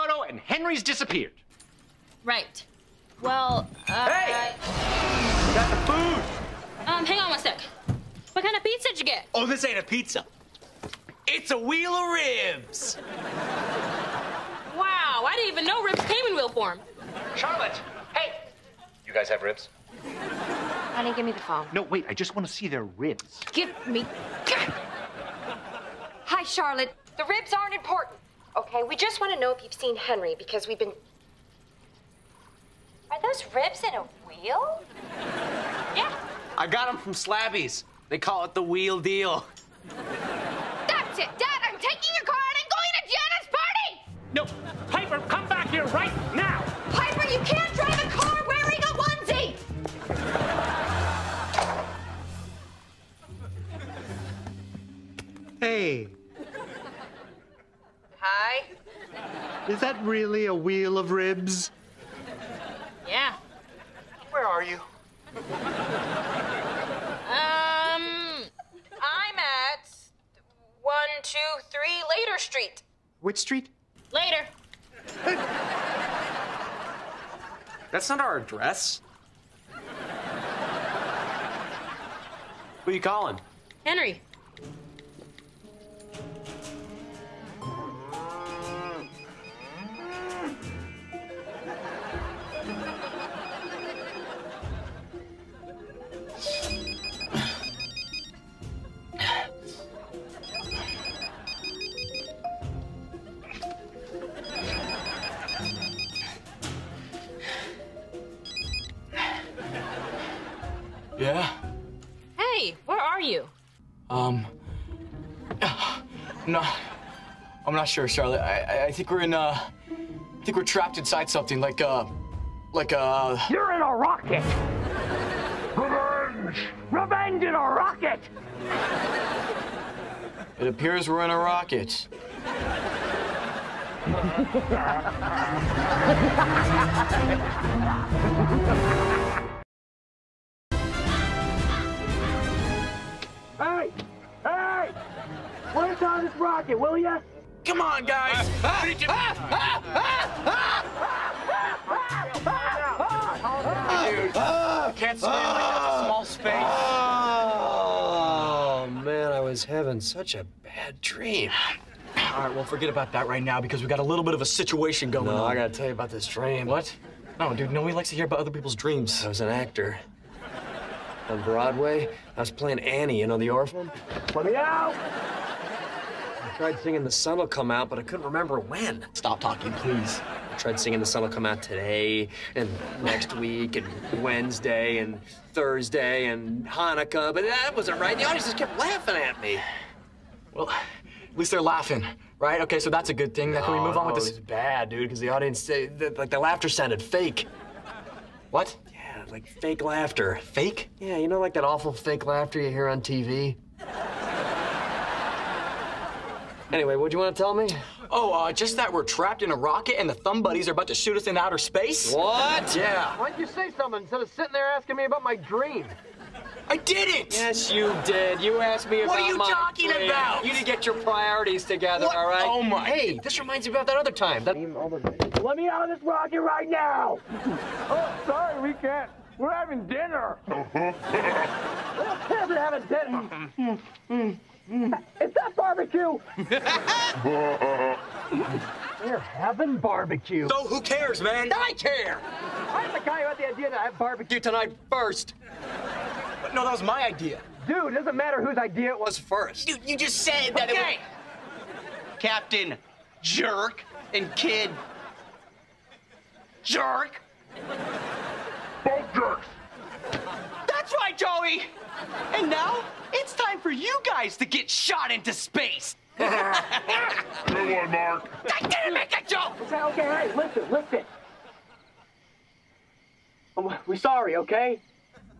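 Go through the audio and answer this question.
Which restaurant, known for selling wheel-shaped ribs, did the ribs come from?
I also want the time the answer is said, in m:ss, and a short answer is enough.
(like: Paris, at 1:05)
Slabby's, at 0:37.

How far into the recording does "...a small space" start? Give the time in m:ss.
2:36.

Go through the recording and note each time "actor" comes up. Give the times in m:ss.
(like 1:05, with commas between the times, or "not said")
2:49.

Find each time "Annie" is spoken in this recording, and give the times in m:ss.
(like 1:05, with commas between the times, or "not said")
2:52.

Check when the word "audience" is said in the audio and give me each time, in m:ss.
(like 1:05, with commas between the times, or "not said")
3:08, 3:15.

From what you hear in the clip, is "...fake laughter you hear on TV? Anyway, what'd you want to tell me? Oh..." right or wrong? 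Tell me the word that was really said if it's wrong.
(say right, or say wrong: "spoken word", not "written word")
right.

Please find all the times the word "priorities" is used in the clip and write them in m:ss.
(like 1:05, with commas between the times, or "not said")
3:40.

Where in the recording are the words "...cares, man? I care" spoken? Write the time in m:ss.
4:00.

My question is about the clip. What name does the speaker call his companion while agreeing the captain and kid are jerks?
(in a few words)
Joey.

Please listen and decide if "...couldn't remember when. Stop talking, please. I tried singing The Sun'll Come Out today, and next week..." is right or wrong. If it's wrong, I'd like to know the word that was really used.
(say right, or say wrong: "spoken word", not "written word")
right.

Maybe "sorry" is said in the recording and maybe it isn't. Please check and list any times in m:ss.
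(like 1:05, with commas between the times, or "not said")
3:48, 4:33.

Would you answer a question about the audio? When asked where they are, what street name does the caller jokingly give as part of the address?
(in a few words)
Later Street.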